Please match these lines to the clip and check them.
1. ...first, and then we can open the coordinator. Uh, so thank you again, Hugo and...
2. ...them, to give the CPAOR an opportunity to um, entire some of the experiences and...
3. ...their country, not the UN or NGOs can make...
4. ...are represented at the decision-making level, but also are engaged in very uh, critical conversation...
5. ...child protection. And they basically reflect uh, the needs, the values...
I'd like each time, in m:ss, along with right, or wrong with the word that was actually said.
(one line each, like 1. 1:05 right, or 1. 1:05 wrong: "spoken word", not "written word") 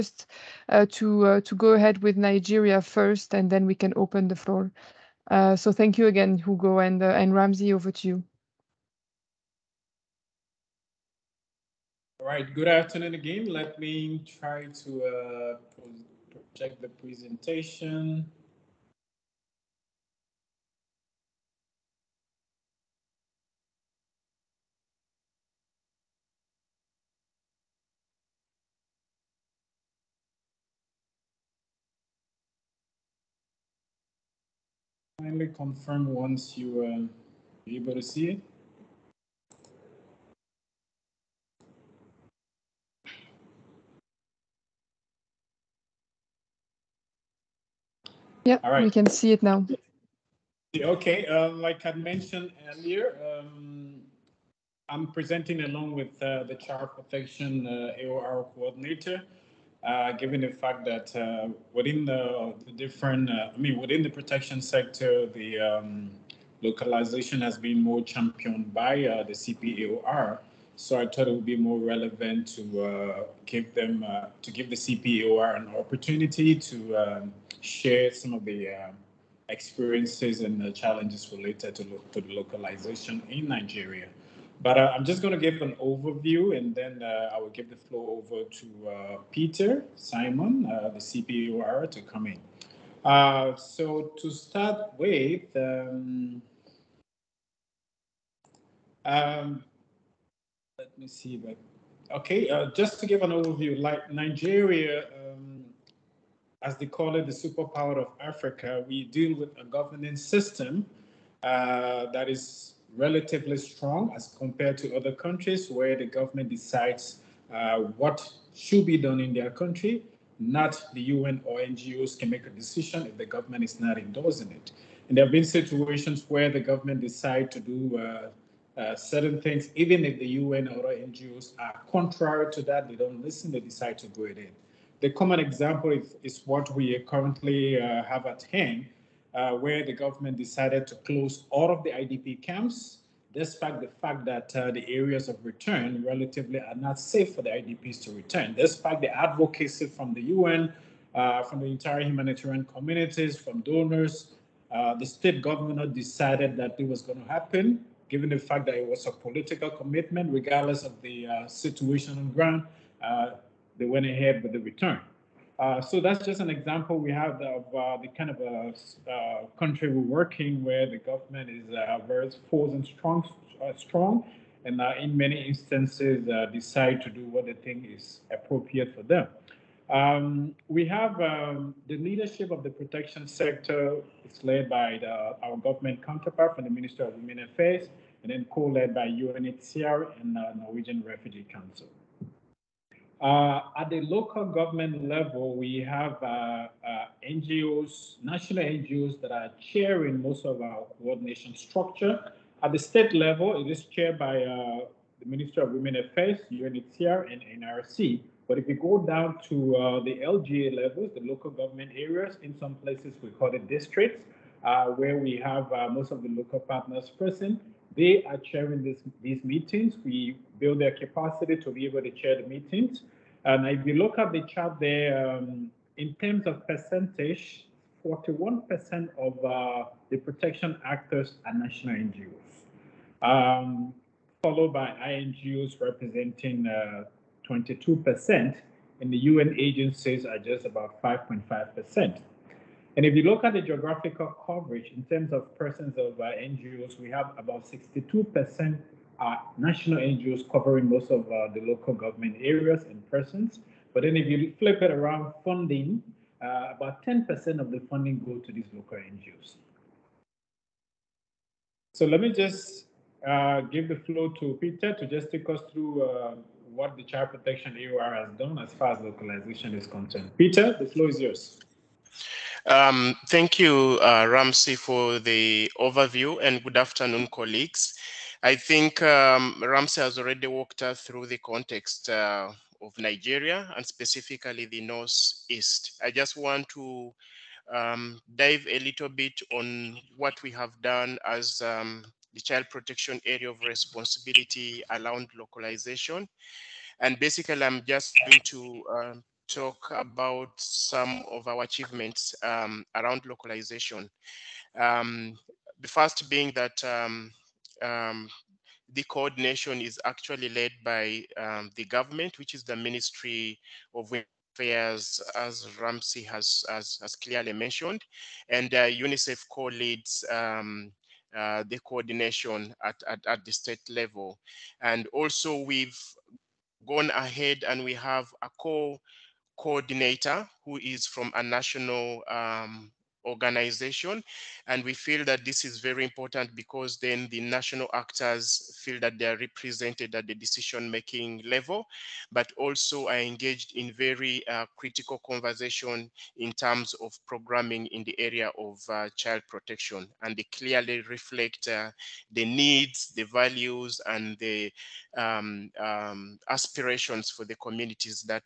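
1. 0:02 wrong: "floor", not "coordinator"
2. 1:13 wrong: "share", not "entire"
3. 1:59 right
4. 5:39 right
5. 5:49 wrong: "clearly", not "basically".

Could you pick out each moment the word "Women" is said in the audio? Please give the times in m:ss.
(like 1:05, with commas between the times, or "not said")
3:07, 3:25, 5:14.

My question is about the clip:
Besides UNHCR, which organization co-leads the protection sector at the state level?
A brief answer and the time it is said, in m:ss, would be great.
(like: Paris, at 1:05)
Norwegian Refugee Council, at 3:10.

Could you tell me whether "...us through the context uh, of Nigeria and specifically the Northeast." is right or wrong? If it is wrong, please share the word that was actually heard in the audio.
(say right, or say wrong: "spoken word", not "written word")
right.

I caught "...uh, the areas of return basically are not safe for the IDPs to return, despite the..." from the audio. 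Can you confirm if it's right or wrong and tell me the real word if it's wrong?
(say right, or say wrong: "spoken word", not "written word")
wrong: "relatively", not "basically".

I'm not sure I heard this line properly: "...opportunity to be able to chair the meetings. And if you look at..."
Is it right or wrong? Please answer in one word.
wrong.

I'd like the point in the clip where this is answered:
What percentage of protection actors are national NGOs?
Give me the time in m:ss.
3:48.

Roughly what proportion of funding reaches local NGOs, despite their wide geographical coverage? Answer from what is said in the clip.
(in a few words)
10%.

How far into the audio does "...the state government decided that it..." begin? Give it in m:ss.
2:34.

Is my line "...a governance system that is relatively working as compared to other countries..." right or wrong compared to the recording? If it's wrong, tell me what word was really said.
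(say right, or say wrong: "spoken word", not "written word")
wrong: "strong", not "working".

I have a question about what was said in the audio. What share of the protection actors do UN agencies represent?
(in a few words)
5.5%.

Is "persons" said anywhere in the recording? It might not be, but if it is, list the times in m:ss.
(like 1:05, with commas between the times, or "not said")
4:05, 4:13.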